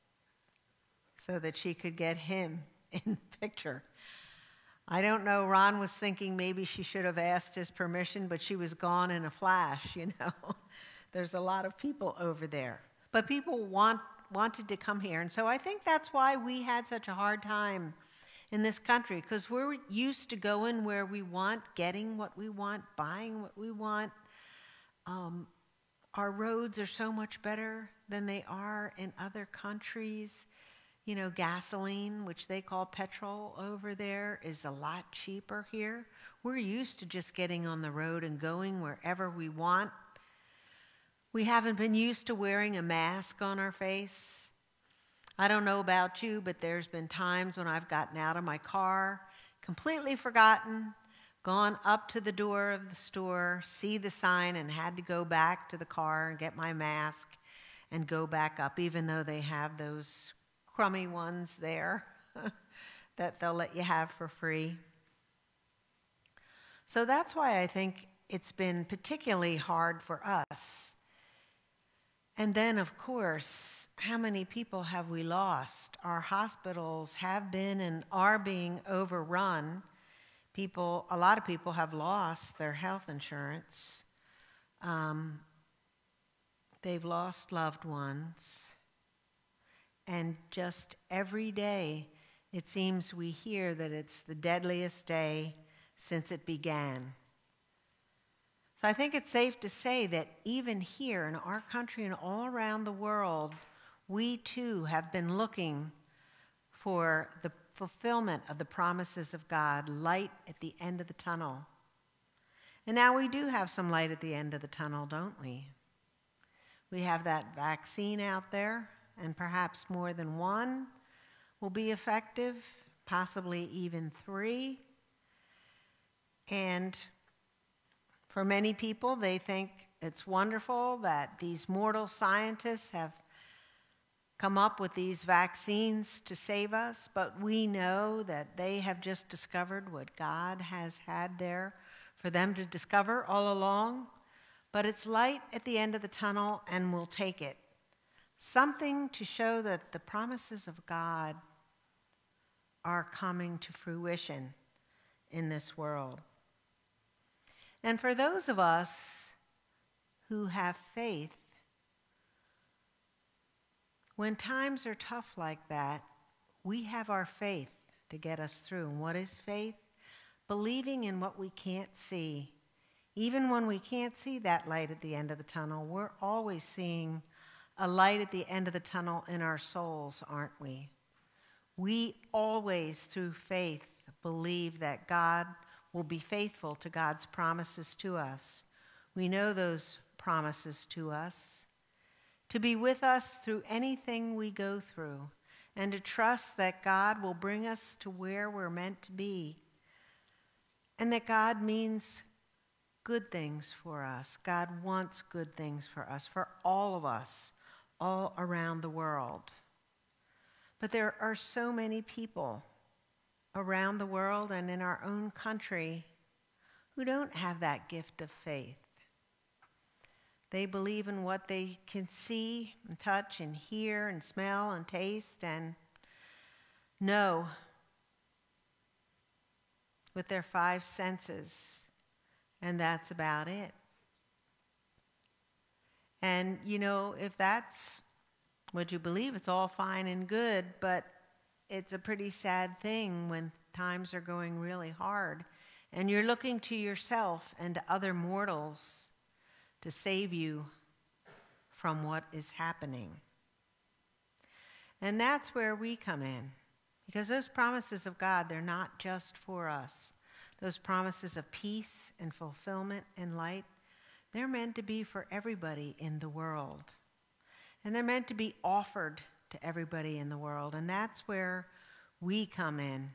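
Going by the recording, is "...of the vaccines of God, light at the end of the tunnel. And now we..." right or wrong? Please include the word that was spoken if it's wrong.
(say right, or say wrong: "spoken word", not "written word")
wrong: "promises", not "vaccines".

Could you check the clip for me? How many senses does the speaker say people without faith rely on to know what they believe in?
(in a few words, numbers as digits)
5.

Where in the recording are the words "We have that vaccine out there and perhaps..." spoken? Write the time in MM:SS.
01:56.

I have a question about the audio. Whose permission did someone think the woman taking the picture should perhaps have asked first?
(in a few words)
Ron.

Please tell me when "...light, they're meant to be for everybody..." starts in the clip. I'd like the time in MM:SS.
04:23.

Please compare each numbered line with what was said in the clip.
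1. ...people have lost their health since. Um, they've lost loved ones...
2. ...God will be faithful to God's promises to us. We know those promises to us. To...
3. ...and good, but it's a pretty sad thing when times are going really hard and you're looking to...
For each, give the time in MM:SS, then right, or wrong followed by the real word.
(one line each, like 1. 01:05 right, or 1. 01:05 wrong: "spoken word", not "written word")
1. 01:21 wrong: "insurance", not "since"
2. 03:05 right
3. 04:00 right.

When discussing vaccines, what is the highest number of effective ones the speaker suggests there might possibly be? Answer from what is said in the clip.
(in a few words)
3.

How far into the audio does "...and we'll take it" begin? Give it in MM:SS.
02:26.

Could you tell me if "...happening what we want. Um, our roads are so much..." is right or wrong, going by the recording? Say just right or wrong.
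wrong.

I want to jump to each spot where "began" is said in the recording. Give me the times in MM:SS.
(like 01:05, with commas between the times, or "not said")
01:36.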